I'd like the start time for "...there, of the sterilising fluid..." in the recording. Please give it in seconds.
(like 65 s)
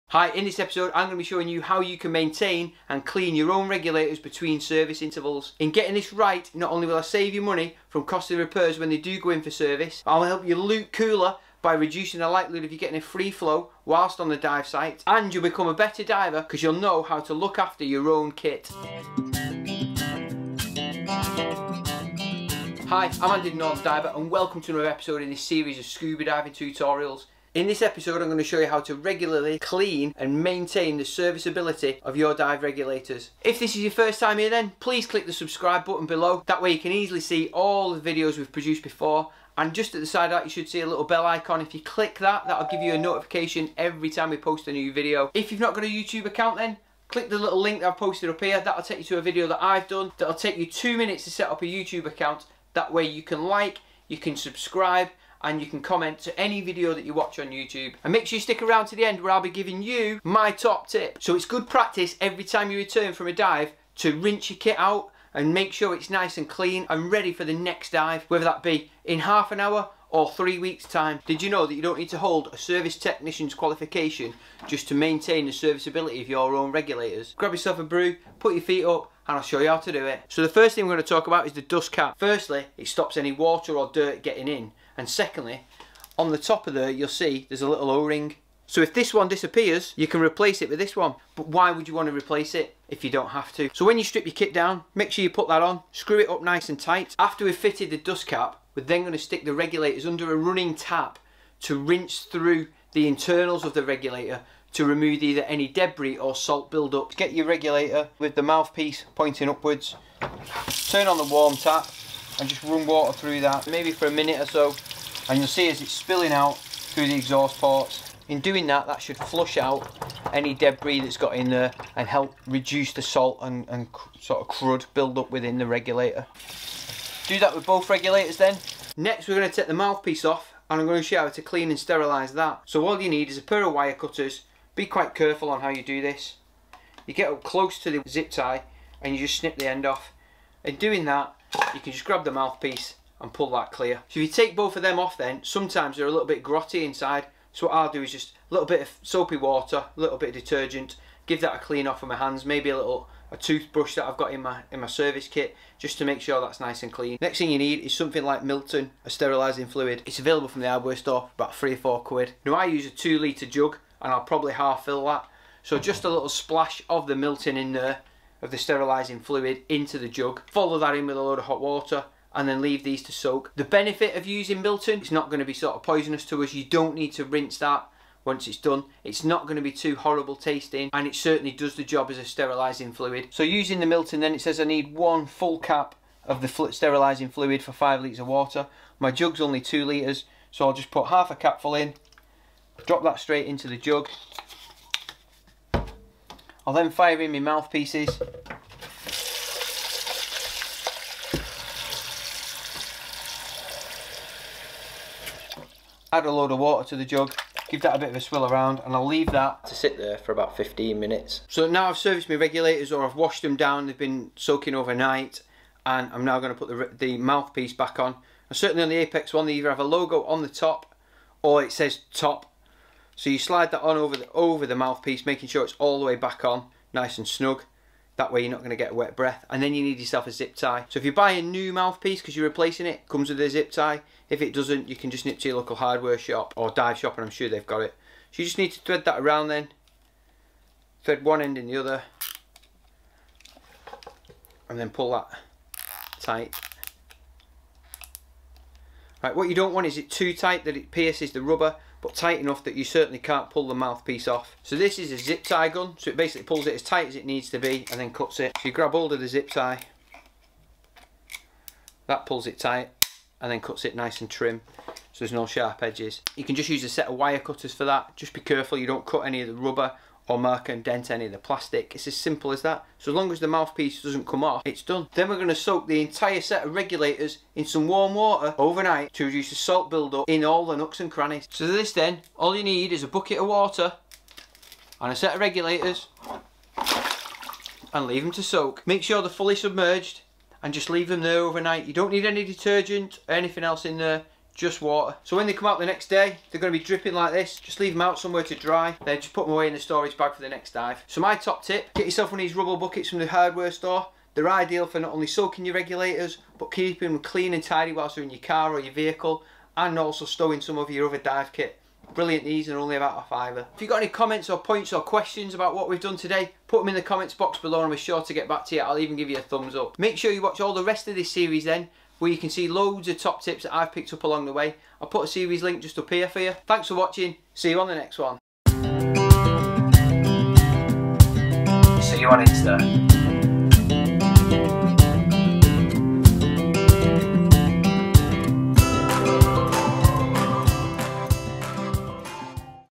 167 s.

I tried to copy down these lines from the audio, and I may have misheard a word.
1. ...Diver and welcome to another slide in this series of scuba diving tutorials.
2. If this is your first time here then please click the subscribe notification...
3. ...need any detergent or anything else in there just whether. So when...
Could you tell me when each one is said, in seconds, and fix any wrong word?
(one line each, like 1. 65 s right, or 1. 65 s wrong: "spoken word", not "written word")
1. 23 s wrong: "episode", not "slide"
2. 33 s wrong: "button", not "notification"
3. 292 s wrong: "water", not "whether".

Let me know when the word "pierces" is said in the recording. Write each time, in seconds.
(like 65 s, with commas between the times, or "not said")
250 s.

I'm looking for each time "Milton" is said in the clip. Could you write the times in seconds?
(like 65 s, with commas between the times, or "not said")
158 s, 167 s, 174 s, 183 s.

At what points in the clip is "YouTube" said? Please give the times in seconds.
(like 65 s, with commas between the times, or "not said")
45 s, 51 s, 57 s.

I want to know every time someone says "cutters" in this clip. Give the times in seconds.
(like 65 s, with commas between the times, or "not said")
133 s, 267 s.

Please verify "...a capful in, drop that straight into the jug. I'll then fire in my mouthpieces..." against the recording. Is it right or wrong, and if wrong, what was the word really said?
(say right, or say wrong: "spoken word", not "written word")
right.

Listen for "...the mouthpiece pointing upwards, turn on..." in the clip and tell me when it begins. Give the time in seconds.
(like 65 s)
108 s.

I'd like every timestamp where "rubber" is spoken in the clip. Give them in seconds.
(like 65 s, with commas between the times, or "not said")
251 s, 269 s, 302 s.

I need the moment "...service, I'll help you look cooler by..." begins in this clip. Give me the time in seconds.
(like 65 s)
9 s.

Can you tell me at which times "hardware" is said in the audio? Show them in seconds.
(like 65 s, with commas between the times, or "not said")
160 s, 235 s, 303 s.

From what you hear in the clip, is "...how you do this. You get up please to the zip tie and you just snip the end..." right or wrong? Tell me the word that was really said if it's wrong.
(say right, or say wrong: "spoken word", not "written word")
wrong: "close", not "please".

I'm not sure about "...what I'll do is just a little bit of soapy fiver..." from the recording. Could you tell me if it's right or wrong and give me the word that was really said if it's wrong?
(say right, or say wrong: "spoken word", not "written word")
wrong: "water", not "fiver".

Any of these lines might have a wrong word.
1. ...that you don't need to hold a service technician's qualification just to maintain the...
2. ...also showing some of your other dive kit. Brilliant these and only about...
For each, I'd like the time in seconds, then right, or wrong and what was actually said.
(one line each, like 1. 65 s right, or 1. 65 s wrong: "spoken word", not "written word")
1. 71 s right
2. 309 s wrong: "stowing", not "showing".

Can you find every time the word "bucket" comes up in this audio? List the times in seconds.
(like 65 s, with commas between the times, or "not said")
283 s, 302 s.